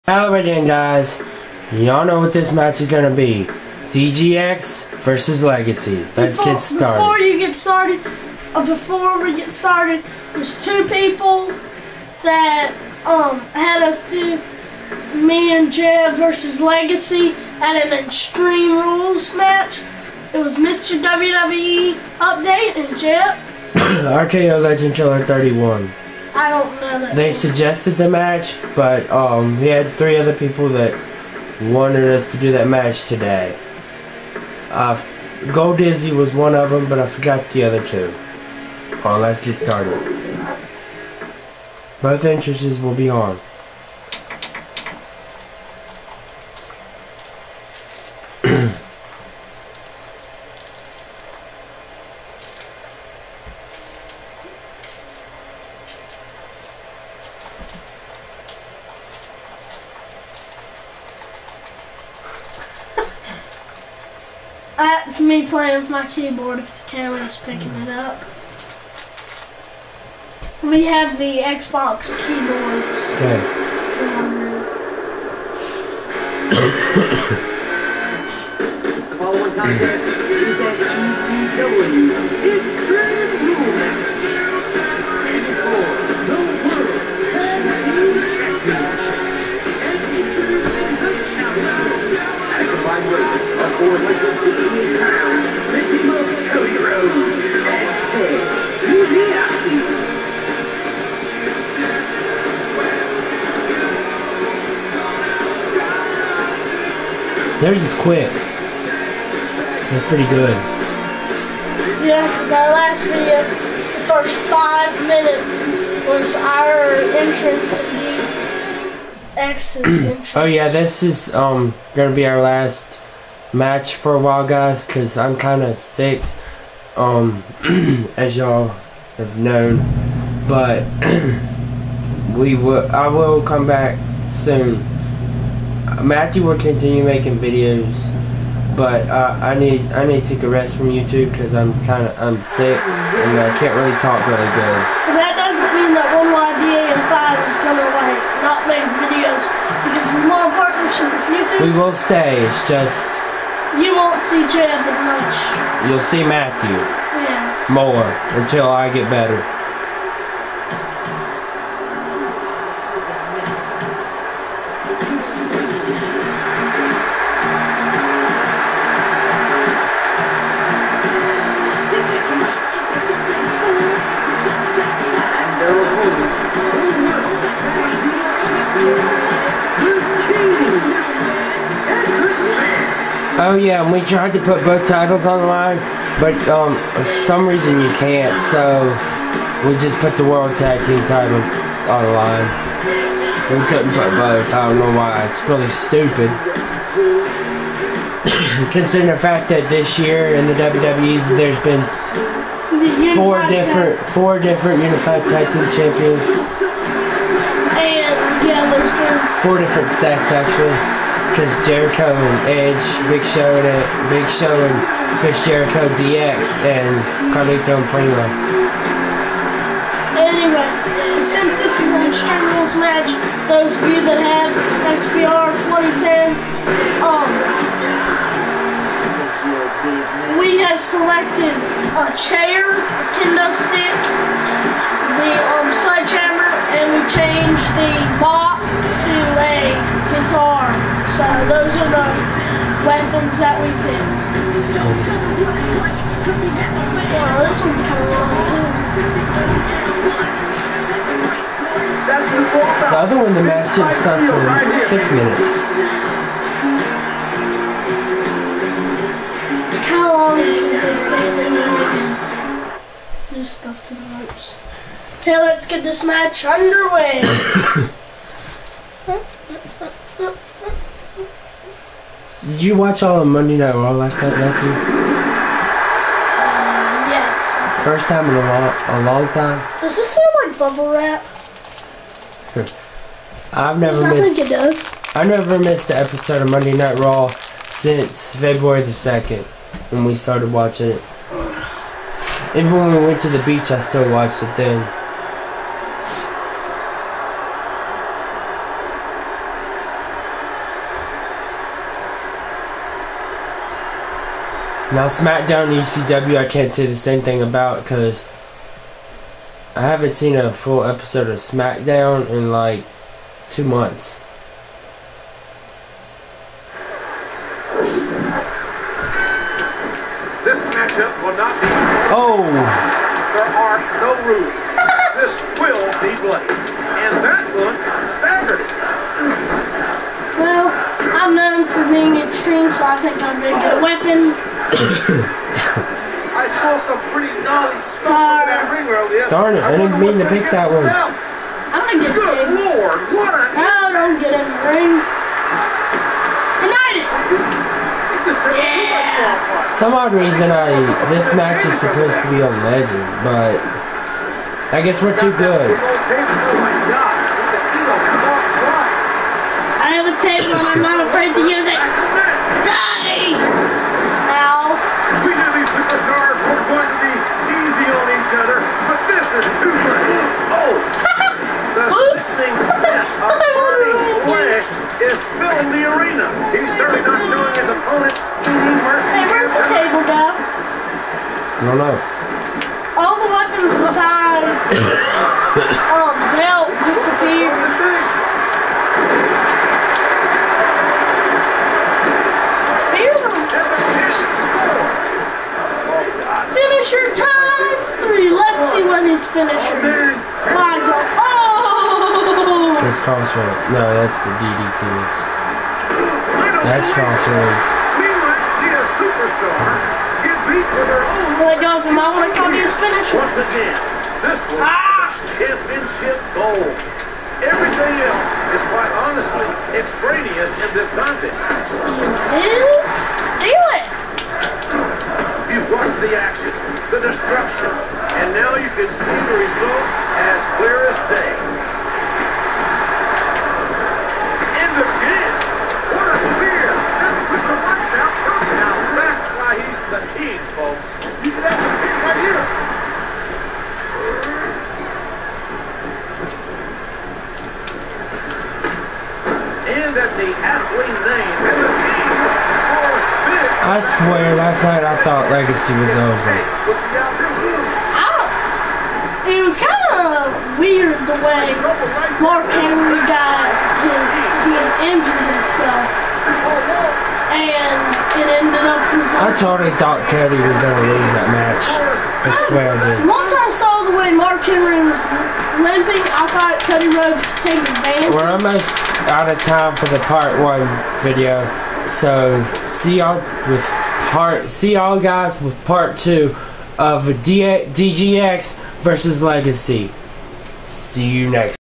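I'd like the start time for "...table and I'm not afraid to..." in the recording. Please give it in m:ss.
6:00.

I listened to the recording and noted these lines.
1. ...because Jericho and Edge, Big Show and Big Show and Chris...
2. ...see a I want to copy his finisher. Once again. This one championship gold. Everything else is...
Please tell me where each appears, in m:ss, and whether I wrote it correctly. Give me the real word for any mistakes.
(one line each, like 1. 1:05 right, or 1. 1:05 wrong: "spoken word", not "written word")
1. 3:31 right
2. 6:48 right.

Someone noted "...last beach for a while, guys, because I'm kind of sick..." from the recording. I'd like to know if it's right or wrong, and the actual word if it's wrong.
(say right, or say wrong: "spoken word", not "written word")
wrong: "match", not "beach".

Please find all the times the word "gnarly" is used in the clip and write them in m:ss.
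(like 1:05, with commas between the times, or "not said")
5:37.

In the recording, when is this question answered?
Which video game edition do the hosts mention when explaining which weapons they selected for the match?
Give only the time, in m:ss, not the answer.
3:44.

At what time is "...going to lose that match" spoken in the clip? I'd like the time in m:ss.
7:50.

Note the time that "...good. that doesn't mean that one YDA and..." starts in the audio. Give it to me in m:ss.
2:24.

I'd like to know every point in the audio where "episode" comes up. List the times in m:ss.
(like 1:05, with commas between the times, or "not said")
4:45, 5:10.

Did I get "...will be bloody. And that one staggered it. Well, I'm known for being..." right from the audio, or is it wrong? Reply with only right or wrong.
right.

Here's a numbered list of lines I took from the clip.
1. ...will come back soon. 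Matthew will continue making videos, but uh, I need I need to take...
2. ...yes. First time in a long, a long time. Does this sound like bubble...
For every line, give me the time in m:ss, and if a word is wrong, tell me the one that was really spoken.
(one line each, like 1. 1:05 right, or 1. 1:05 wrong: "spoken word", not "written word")
1. 2:13 right
2. 4:37 right.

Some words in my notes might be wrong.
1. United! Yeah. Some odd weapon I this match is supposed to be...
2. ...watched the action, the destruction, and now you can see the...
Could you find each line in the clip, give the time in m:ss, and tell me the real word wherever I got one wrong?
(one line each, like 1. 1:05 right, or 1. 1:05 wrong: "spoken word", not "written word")
1. 5:46 wrong: "reason", not "weapon"
2. 7:05 right.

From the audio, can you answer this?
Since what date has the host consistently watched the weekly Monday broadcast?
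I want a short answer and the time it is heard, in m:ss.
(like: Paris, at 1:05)
February 2, at 4:48.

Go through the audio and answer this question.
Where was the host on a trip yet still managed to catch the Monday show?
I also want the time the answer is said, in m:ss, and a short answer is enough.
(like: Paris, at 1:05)
the beach, at 4:53.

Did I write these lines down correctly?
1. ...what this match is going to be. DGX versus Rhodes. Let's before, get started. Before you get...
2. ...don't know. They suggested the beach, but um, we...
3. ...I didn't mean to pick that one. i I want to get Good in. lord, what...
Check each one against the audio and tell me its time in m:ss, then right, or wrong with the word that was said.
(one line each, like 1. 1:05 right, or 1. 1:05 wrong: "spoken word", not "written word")
1. 0:02 wrong: "Legacy", not "Rhodes"
2. 0:26 wrong: "match", not "beach"
3. 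5:39 right.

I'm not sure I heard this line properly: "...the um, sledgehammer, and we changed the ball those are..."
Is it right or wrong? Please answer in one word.
right.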